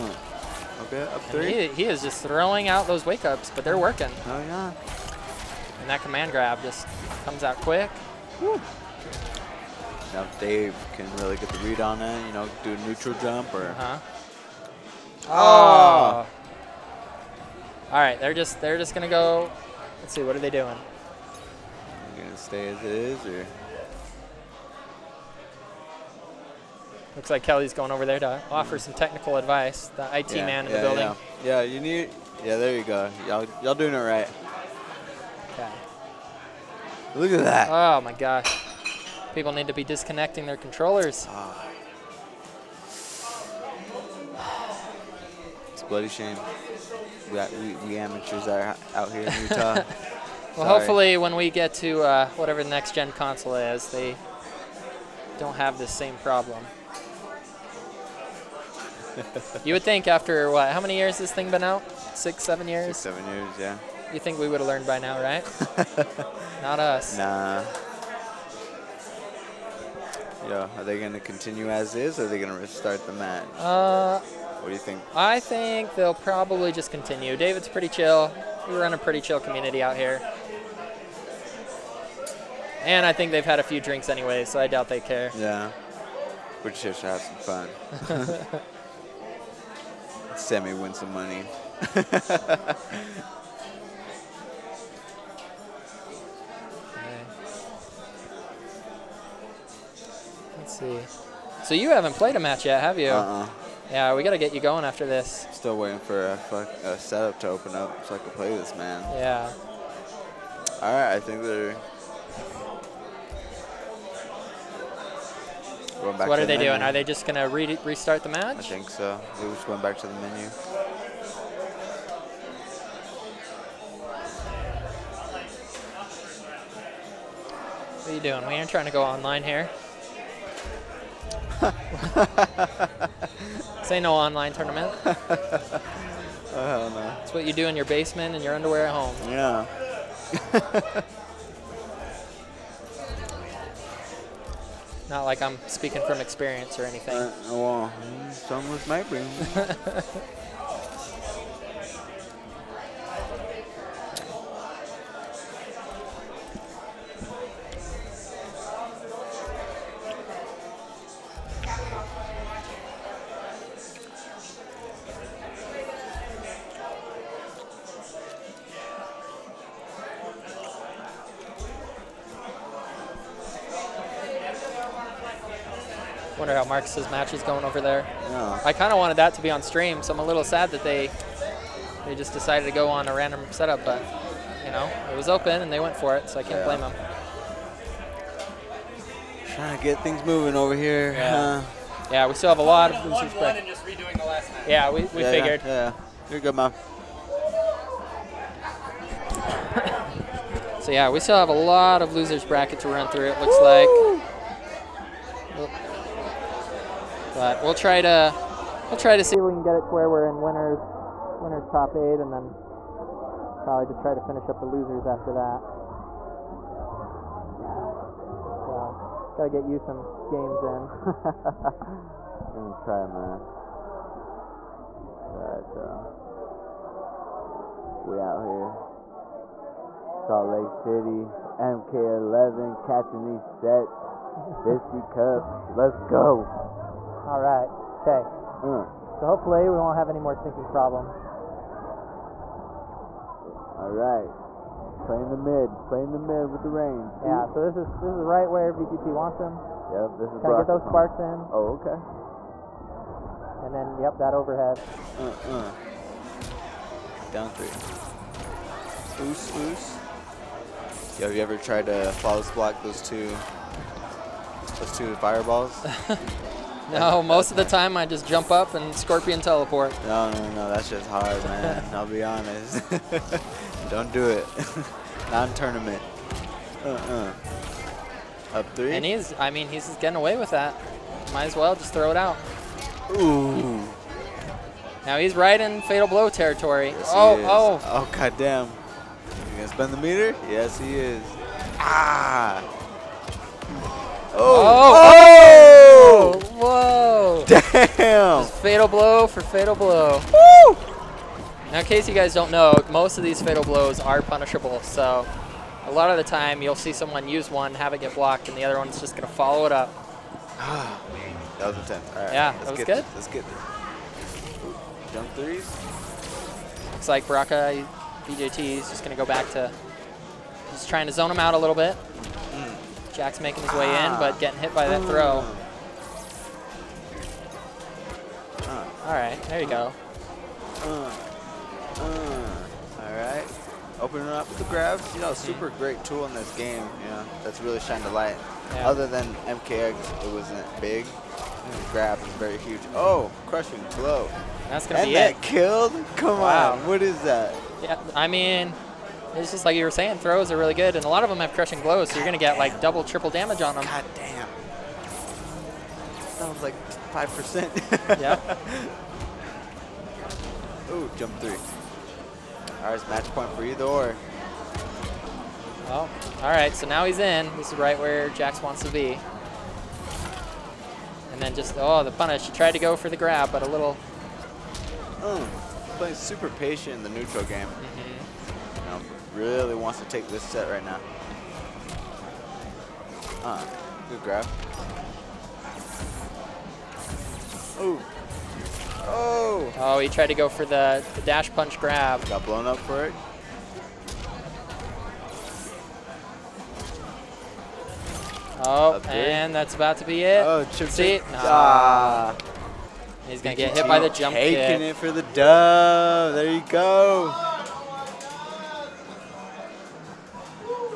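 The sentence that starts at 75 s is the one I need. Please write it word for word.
I think they'll probably just continue.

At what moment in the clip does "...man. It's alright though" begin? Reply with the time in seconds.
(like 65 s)
223 s.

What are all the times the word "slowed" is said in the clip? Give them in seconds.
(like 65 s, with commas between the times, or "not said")
not said.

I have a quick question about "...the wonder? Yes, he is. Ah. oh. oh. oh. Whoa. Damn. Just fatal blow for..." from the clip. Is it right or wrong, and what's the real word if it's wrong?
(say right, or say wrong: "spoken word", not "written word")
wrong: "meter", not "wonder".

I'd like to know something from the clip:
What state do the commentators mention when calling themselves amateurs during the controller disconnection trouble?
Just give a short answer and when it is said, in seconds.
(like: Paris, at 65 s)
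Utah, at 49 s.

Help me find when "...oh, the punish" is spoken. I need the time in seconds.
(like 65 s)
371 s.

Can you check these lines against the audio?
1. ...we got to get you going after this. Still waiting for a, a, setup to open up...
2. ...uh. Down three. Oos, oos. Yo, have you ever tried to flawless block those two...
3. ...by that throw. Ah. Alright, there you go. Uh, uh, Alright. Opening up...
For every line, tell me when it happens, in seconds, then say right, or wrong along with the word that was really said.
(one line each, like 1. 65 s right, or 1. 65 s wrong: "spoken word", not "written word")
1. 104 s right
2. 255 s right
3. 324 s right.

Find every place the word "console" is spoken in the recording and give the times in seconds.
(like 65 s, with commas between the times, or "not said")
53 s.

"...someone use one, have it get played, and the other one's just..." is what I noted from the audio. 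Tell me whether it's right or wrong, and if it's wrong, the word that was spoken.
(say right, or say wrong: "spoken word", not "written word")
wrong: "blocked", not "played".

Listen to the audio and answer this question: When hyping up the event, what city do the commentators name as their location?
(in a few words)
Salt Lake City.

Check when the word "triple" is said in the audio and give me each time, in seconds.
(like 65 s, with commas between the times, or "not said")
353 s.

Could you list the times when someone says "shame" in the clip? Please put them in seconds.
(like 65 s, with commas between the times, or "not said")
46 s.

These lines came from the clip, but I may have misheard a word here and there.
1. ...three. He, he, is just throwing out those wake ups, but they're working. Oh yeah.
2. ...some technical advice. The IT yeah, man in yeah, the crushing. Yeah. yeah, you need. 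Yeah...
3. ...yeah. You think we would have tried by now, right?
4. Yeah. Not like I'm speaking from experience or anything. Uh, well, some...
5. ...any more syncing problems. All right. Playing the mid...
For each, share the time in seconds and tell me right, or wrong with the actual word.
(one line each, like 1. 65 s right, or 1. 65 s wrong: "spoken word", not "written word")
1. 1 s right
2. 28 s wrong: "building", not "crushing"
3. 63 s wrong: "learned", not "tried"
4. 139 s right
5. 240 s right.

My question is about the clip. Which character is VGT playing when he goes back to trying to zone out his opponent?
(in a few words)
Baraka.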